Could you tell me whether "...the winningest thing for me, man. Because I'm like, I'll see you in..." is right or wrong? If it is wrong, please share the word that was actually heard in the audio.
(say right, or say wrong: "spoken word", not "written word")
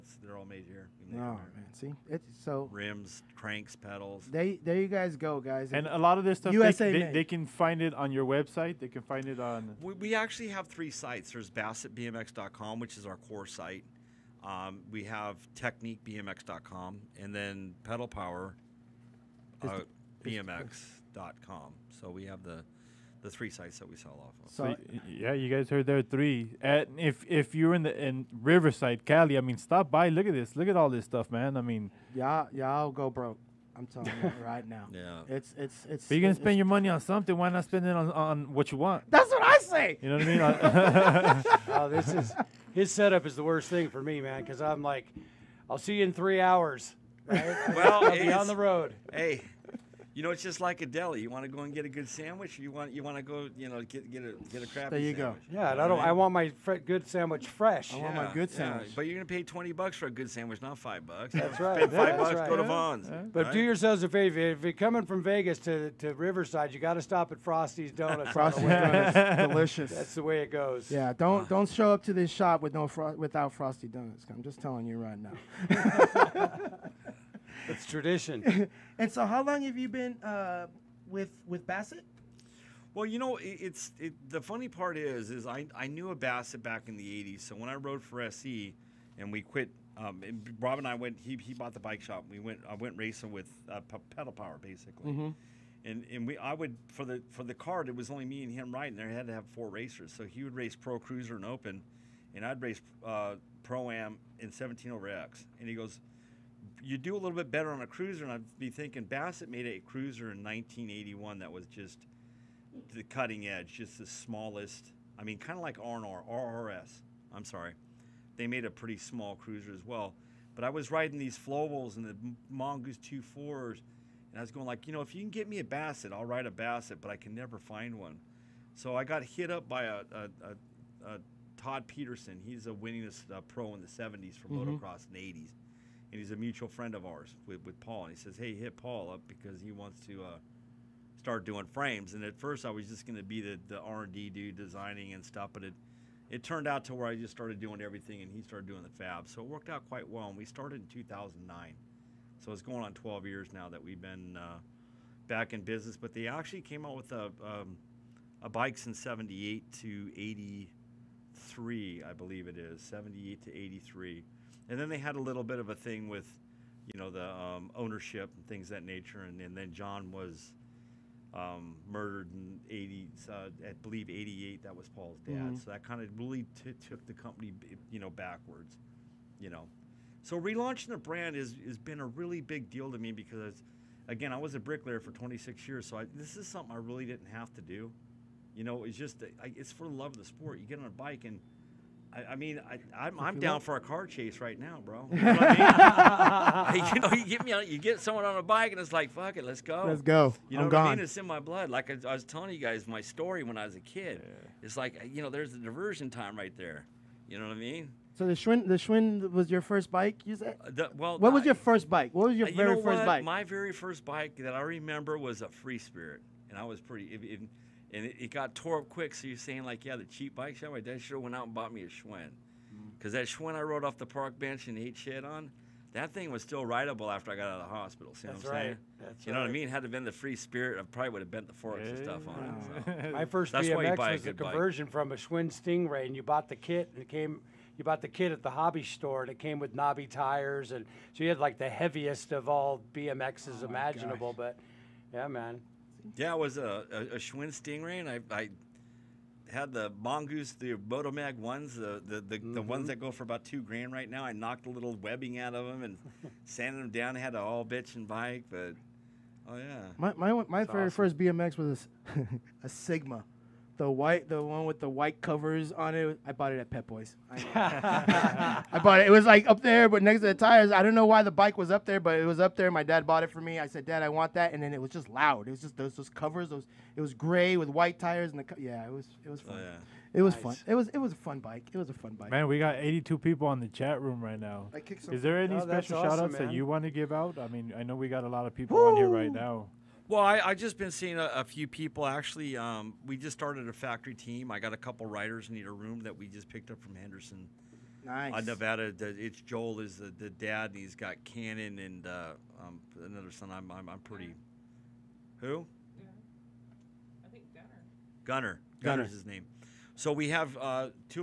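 wrong: "worst", not "winningest".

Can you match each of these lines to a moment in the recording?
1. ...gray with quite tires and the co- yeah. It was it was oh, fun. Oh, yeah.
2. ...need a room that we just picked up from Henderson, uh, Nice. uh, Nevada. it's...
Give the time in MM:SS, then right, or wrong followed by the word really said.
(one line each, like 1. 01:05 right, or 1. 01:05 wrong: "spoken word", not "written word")
1. 04:37 wrong: "white", not "quite"
2. 04:55 right.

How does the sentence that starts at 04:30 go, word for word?
I don't know why the bike was up there, but it was up there.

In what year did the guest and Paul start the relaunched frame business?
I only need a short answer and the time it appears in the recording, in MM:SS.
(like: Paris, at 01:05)
2009, at 02:30.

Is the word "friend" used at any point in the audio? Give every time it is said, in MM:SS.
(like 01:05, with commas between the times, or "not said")
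02:16.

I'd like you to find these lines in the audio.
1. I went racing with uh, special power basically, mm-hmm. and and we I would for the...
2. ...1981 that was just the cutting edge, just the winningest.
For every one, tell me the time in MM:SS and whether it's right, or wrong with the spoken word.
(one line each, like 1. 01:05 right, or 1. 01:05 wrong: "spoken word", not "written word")
1. 01:32 wrong: "pedal", not "special"
2. 01:50 wrong: "smallest", not "winningest".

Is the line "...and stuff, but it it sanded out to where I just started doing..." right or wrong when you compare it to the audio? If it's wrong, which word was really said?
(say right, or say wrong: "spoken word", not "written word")
wrong: "turned", not "sanded".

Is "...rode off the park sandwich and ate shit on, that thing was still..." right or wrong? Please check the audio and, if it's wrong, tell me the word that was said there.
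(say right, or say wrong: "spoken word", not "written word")
wrong: "bench", not "sandwich".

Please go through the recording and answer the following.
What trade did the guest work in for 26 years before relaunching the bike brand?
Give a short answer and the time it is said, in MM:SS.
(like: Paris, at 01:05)
bricklayer, at 03:04.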